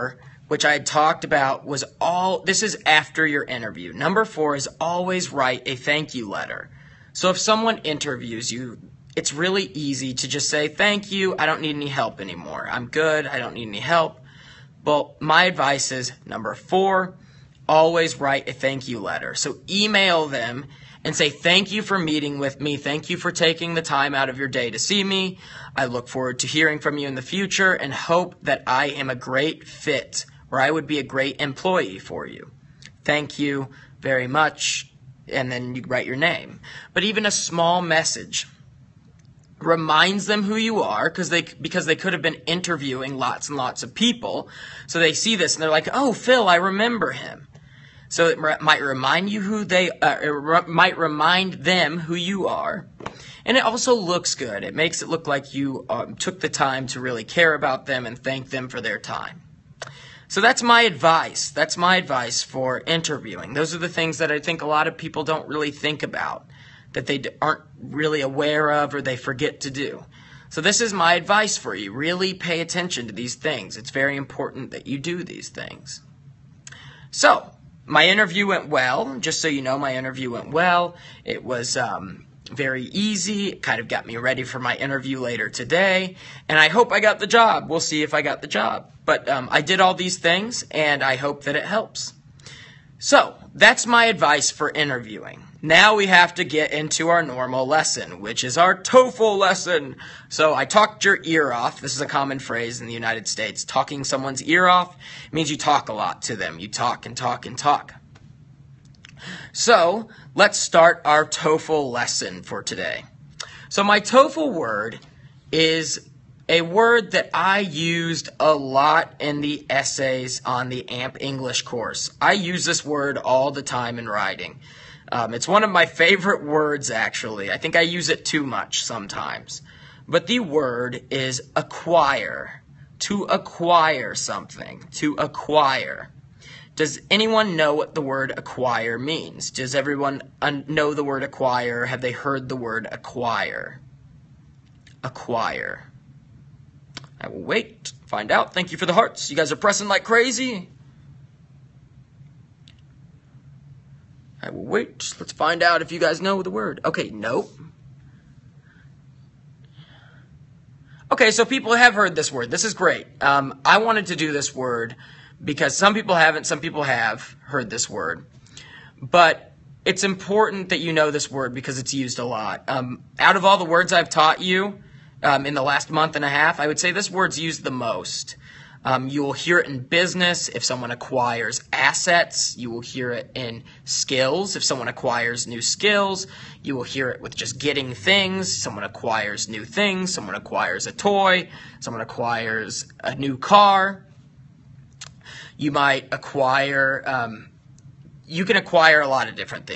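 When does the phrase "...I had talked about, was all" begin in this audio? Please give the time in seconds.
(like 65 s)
0 s.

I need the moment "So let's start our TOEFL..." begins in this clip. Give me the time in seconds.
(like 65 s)
109 s.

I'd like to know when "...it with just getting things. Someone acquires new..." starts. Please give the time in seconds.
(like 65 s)
187 s.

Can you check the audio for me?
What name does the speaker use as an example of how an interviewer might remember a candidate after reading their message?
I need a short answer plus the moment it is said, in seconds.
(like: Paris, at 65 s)
Phil, at 46 s.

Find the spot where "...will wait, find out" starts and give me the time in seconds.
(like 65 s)
147 s.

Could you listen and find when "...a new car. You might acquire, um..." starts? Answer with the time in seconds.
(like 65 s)
193 s.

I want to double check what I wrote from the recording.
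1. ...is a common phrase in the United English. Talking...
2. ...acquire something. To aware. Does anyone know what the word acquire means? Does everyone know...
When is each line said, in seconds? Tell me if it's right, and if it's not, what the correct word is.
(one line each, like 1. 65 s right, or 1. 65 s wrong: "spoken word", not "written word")
1. 101 s wrong: "States", not "English"
2. 133 s wrong: "acquire", not "aware".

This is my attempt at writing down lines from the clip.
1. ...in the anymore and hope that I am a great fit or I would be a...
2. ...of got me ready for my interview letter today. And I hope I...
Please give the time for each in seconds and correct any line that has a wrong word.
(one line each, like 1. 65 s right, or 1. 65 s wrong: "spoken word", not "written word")
1. 27 s wrong: "future", not "anymore"
2. 83 s wrong: "later", not "letter".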